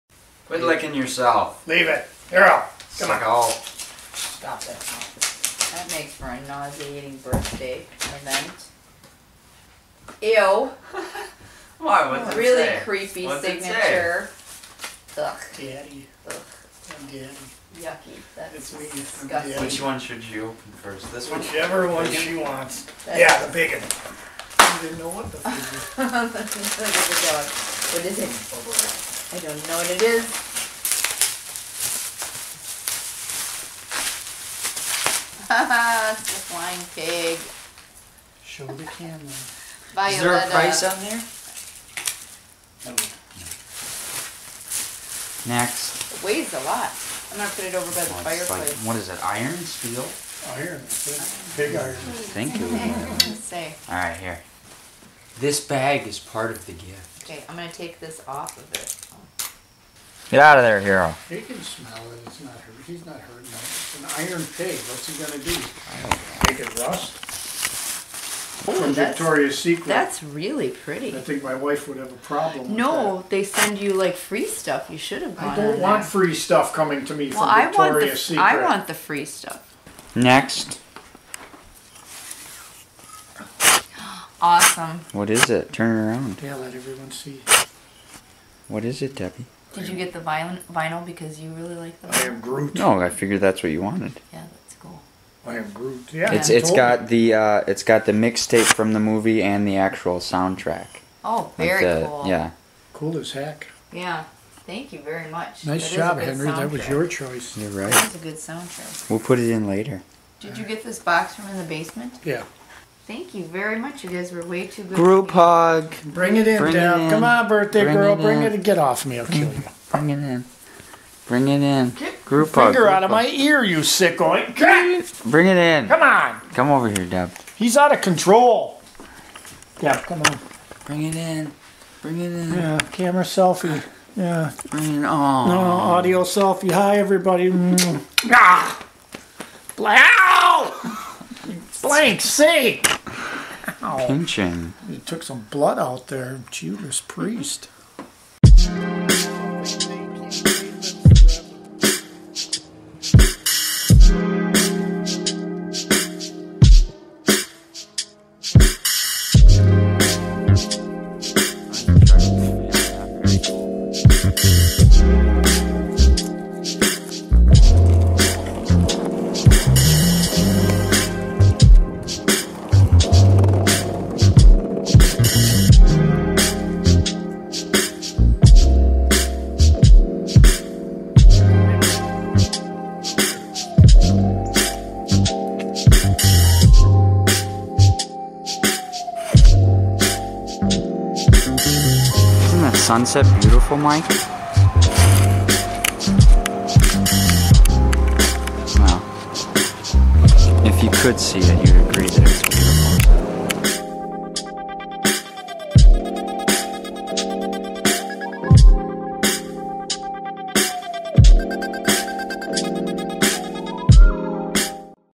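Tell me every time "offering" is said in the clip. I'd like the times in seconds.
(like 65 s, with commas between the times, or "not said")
not said.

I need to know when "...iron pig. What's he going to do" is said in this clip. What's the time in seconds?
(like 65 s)
64 s.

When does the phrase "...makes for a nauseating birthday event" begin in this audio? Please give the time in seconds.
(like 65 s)
5 s.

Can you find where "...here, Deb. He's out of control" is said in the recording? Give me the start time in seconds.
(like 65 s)
126 s.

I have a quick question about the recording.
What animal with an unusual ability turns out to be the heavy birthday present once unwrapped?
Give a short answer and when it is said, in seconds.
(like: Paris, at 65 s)
flying pig, at 36 s.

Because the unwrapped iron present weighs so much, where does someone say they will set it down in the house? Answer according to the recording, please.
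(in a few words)
By the fireplace.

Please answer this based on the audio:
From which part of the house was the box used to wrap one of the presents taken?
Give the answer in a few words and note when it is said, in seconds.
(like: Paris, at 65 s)
Basement, at 111 s.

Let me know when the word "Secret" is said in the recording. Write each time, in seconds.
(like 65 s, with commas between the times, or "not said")
69 s, 78 s.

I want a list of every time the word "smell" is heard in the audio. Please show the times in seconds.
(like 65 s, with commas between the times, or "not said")
61 s.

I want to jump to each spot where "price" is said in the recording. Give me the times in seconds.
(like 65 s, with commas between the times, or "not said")
40 s.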